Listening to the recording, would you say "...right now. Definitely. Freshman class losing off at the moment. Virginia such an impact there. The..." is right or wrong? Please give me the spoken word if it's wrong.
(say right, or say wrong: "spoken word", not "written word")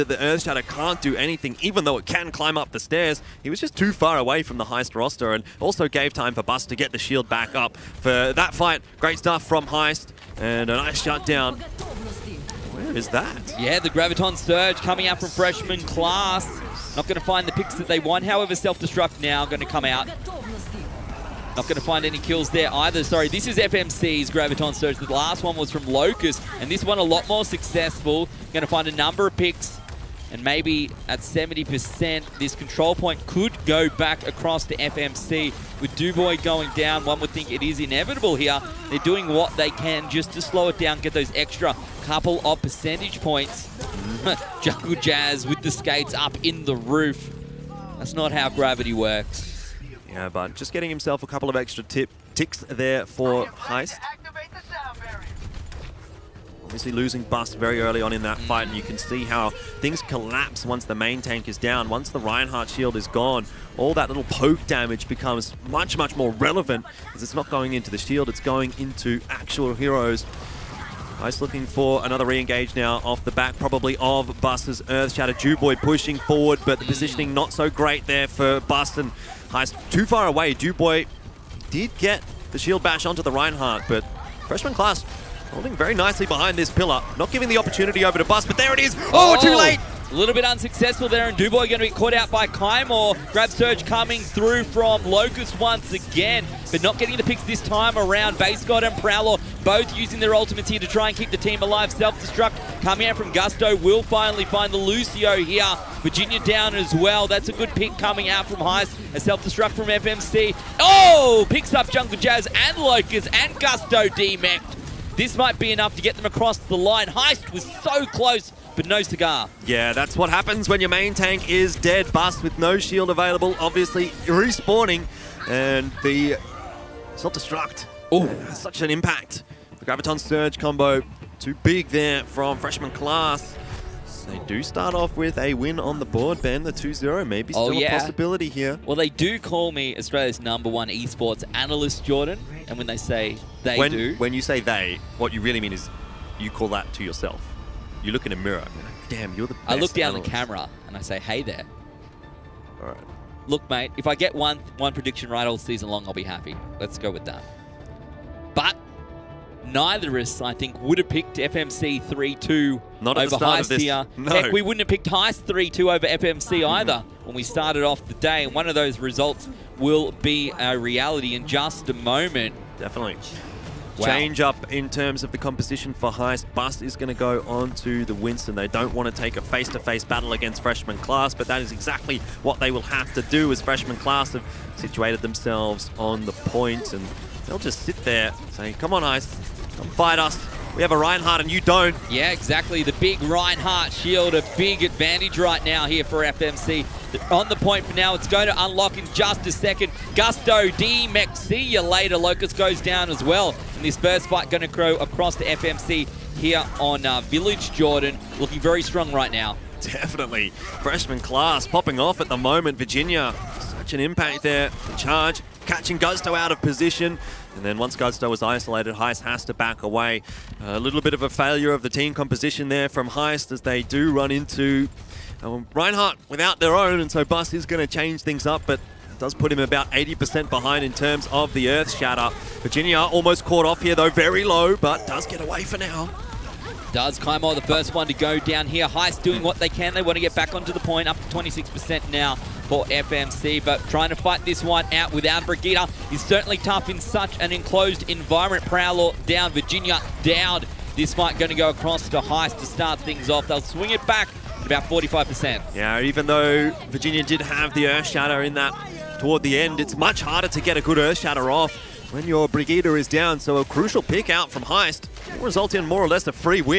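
wrong: "popping", not "losing".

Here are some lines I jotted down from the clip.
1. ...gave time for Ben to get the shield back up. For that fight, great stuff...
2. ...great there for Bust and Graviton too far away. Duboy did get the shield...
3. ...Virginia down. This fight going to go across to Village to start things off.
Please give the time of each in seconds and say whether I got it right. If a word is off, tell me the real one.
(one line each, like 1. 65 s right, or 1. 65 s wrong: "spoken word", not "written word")
1. 5 s wrong: "Bus", not "Ben"
2. 77 s wrong: "Heist", not "Graviton"
3. 249 s wrong: "Heist", not "Village".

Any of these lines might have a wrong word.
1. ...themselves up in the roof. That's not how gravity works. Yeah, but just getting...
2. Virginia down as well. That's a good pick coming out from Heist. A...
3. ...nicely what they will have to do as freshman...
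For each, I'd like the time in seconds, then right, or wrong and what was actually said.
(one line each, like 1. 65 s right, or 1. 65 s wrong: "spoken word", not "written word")
1. 45 s wrong: "skates", not "themselves"
2. 106 s right
3. 181 s wrong: "exactly", not "nicely".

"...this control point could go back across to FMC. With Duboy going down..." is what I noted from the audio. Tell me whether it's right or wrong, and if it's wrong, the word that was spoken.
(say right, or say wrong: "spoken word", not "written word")
right.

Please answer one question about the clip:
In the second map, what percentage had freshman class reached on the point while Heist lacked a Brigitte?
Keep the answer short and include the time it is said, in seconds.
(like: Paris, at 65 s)
26%, at 241 s.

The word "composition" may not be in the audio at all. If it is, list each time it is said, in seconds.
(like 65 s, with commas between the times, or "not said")
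175 s, 222 s.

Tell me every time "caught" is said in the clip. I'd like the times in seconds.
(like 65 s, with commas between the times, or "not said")
91 s, 233 s.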